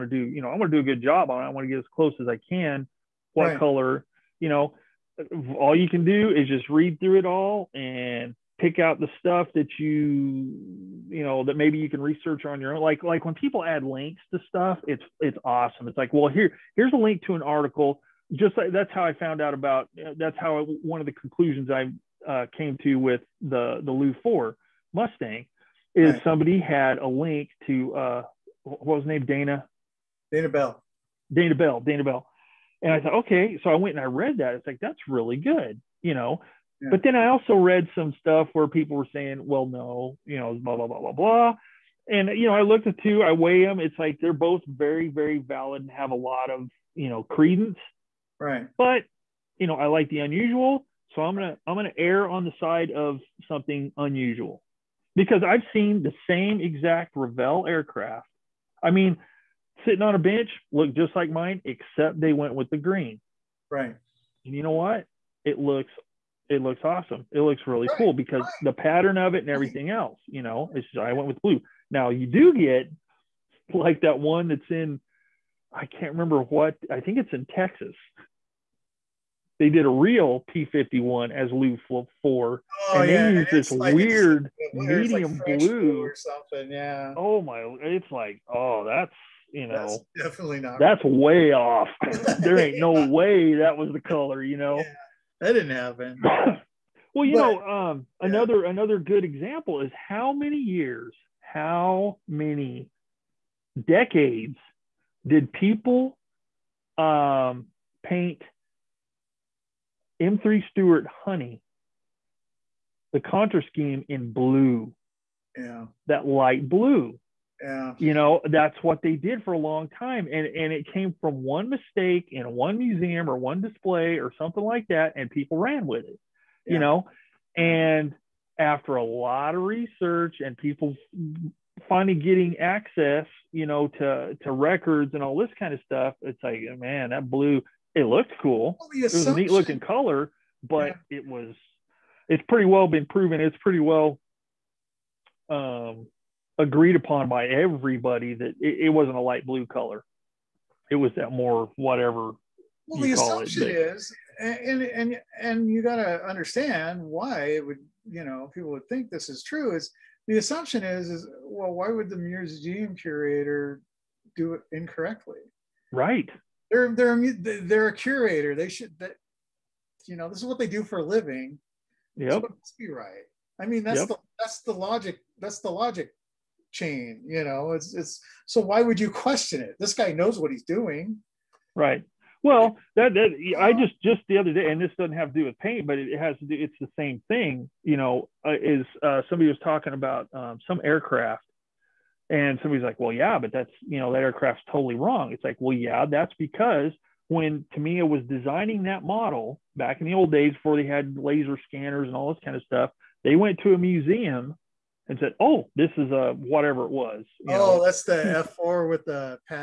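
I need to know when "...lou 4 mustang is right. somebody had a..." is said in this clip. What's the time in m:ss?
0:23.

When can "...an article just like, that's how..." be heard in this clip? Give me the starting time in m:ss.
0:17.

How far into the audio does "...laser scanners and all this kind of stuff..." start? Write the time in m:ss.
3:21.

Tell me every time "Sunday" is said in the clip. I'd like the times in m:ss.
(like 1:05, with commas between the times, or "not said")
not said.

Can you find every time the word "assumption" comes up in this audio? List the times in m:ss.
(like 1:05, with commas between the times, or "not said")
2:33, 2:40.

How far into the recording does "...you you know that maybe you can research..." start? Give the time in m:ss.
0:09.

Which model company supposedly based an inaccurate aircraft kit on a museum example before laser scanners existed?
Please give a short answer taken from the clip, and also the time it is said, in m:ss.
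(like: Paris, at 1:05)
Tamiya, at 3:17.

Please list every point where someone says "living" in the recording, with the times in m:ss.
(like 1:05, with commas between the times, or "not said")
2:51.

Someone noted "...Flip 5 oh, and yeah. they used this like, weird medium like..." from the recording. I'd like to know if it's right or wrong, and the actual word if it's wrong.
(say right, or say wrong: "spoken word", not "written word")
wrong: "4", not "5".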